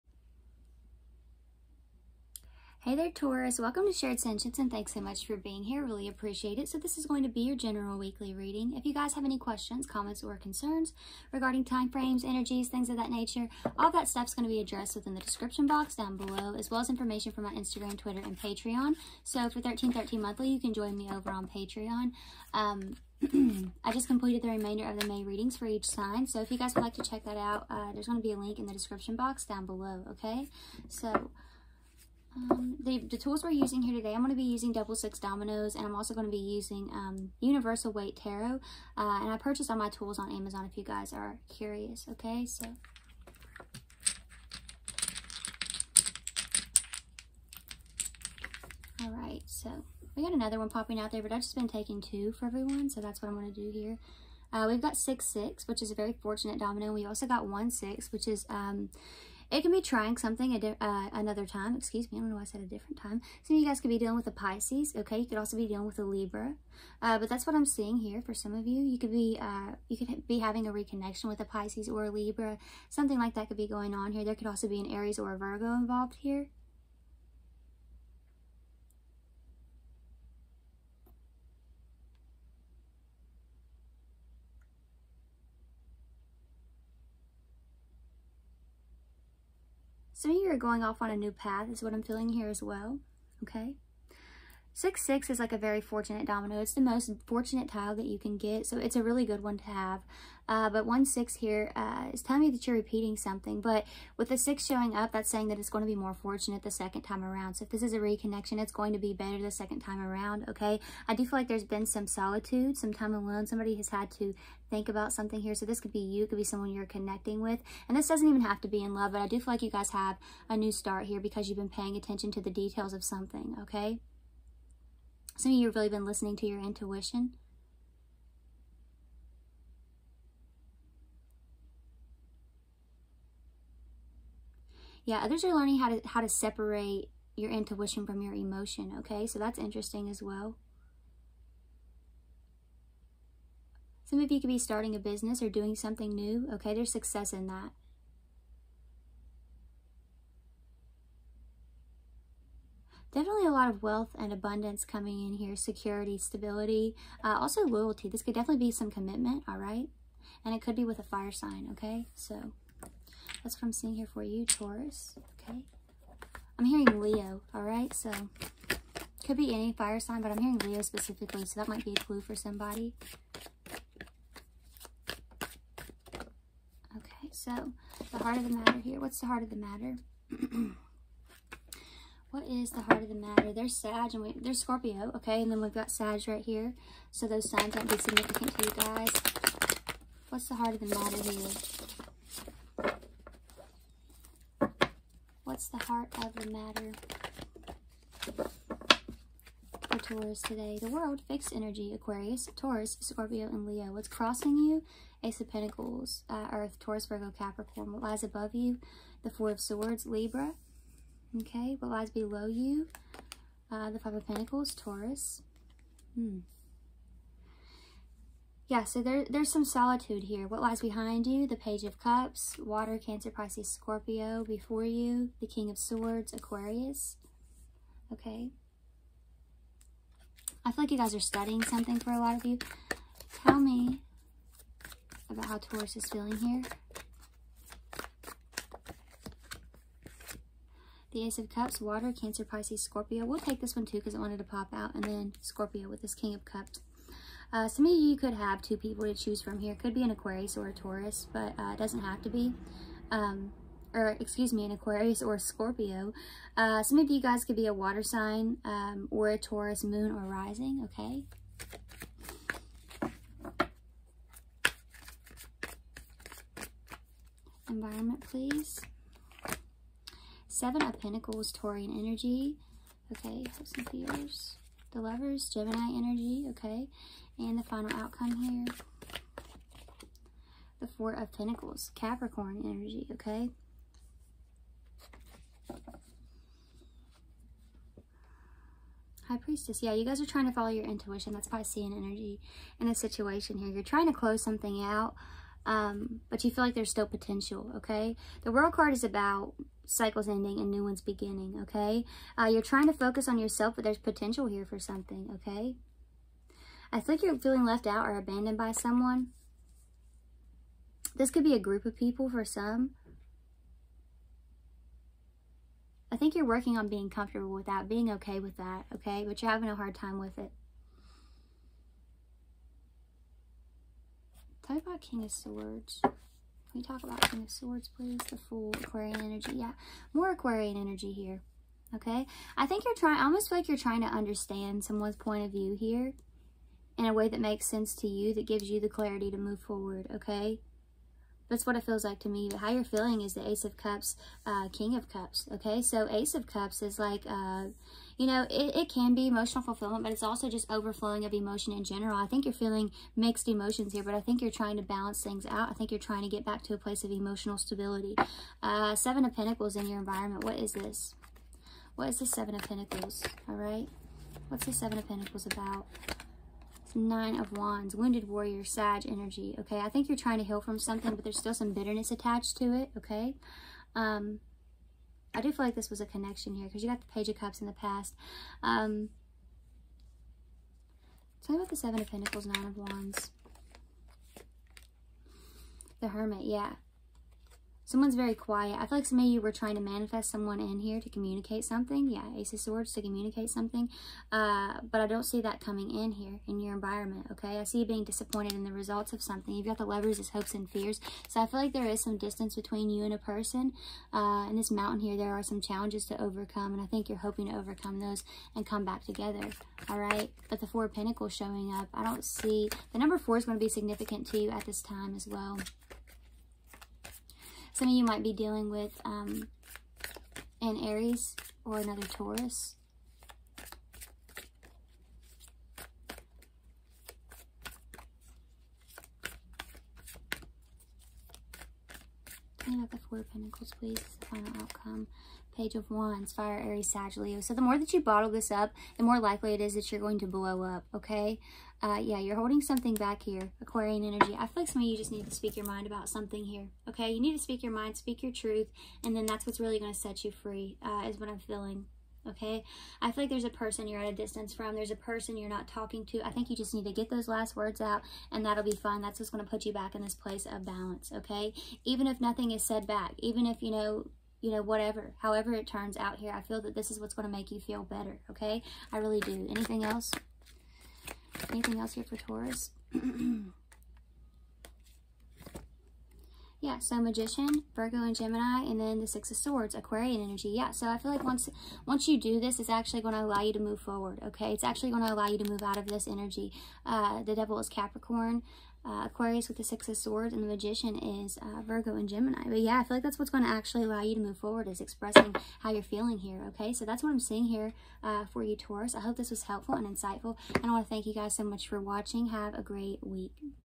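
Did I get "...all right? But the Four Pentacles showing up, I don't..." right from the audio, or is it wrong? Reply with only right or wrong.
right.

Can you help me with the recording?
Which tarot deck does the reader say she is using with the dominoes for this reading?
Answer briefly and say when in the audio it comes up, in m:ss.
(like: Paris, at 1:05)
Universal Waite, at 0:37.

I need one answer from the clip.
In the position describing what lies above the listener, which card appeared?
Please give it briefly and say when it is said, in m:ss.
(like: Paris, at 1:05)
Four of Swords, at 3:29.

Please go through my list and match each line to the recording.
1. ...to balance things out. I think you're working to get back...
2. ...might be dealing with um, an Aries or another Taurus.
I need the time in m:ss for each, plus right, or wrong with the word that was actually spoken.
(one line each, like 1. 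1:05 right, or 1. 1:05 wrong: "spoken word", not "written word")
1. 5:54 wrong: "trying", not "working"
2. 6:58 right.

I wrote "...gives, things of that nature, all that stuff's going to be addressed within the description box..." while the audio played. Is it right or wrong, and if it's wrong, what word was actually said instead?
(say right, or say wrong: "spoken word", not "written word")
wrong: "energies", not "gives".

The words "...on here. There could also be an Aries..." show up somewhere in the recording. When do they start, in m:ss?
1:13.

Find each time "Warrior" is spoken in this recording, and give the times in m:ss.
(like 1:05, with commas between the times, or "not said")
6:08.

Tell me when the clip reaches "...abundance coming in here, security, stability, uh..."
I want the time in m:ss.
2:34.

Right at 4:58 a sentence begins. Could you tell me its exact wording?
The world card is about cycles ending and new ones beginning, okay?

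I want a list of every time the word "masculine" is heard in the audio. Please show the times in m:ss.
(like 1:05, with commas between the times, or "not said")
not said.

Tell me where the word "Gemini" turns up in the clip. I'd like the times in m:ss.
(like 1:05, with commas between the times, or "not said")
4:35, 7:58, 8:12.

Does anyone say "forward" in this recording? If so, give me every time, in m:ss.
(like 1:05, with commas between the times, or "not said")
5:39, 8:03, 8:14.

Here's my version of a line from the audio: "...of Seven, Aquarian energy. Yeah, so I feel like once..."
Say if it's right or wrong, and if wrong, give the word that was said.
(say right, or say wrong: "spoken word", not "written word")
wrong: "Swords", not "Seven".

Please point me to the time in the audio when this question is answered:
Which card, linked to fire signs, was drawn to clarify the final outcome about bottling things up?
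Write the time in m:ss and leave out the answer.
7:15.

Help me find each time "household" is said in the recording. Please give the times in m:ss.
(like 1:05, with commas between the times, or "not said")
not said.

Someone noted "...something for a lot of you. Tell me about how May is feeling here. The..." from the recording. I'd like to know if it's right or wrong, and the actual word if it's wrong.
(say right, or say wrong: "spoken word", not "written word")
wrong: "Taurus", not "May".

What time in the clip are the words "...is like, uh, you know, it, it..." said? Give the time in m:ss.
5:46.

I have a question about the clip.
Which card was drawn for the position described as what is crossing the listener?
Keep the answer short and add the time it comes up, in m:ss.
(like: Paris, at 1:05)
Ace of Pentacles, at 3:25.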